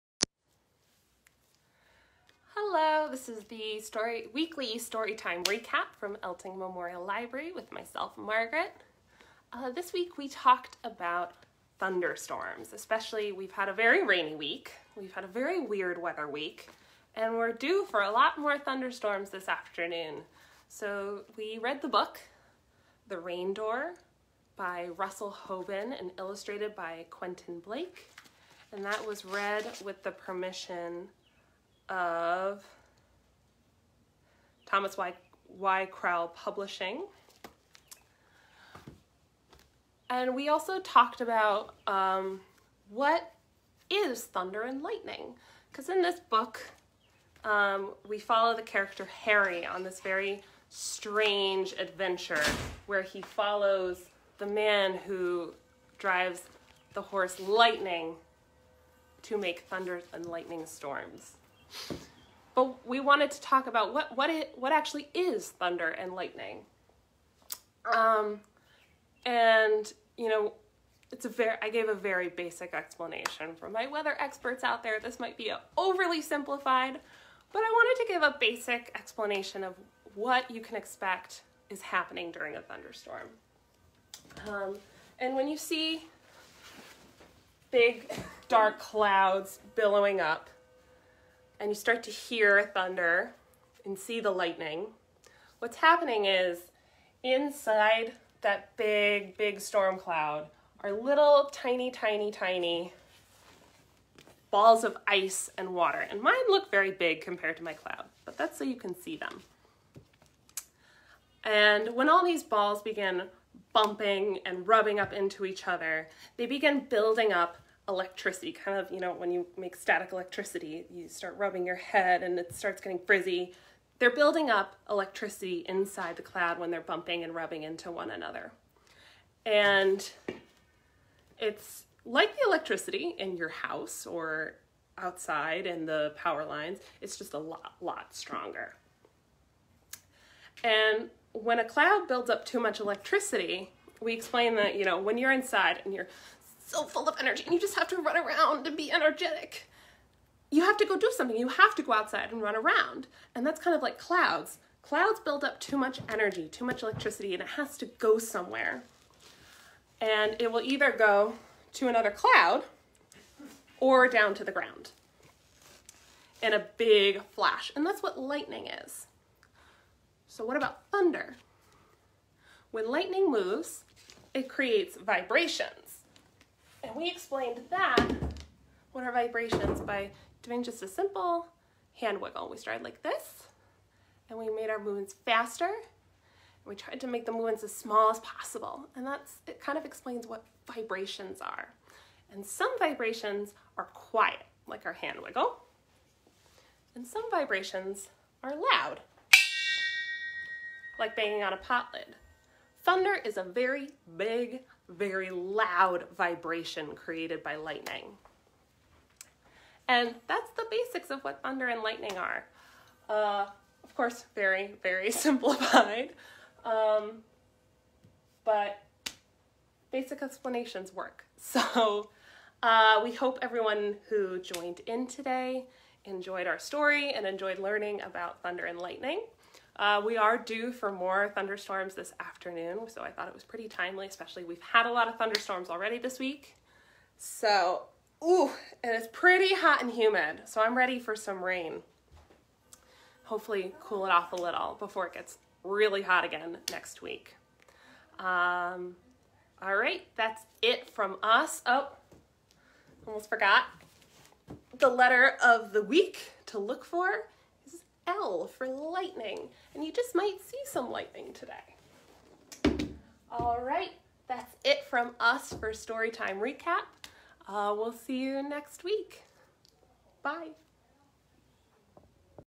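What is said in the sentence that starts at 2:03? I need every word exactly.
They're building up electricity inside the cloud when they're bumping and rubbing into one another.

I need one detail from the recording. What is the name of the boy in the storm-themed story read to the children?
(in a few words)
Harry.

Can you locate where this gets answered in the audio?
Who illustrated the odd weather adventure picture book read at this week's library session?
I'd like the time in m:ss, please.
0:27.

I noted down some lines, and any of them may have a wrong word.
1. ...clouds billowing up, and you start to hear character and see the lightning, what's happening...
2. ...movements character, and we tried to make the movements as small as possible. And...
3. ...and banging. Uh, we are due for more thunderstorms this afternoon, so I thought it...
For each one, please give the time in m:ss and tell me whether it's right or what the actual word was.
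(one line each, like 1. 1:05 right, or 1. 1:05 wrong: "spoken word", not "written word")
1. 1:28 wrong: "thunder", not "character"
2. 3:04 wrong: "faster", not "character"
3. 3:48 wrong: "lightning", not "banging".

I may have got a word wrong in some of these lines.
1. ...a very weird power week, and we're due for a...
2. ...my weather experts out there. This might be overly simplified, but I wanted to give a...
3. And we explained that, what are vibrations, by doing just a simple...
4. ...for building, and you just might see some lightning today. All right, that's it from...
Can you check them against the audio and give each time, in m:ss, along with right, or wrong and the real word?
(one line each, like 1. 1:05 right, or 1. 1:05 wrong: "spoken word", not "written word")
1. 0:15 wrong: "weather", not "power"
2. 1:13 right
3. 2:56 right
4. 4:18 wrong: "lightning", not "building".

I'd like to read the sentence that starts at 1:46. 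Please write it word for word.
And mine look very big compared to my cloud, but that's so you can see them.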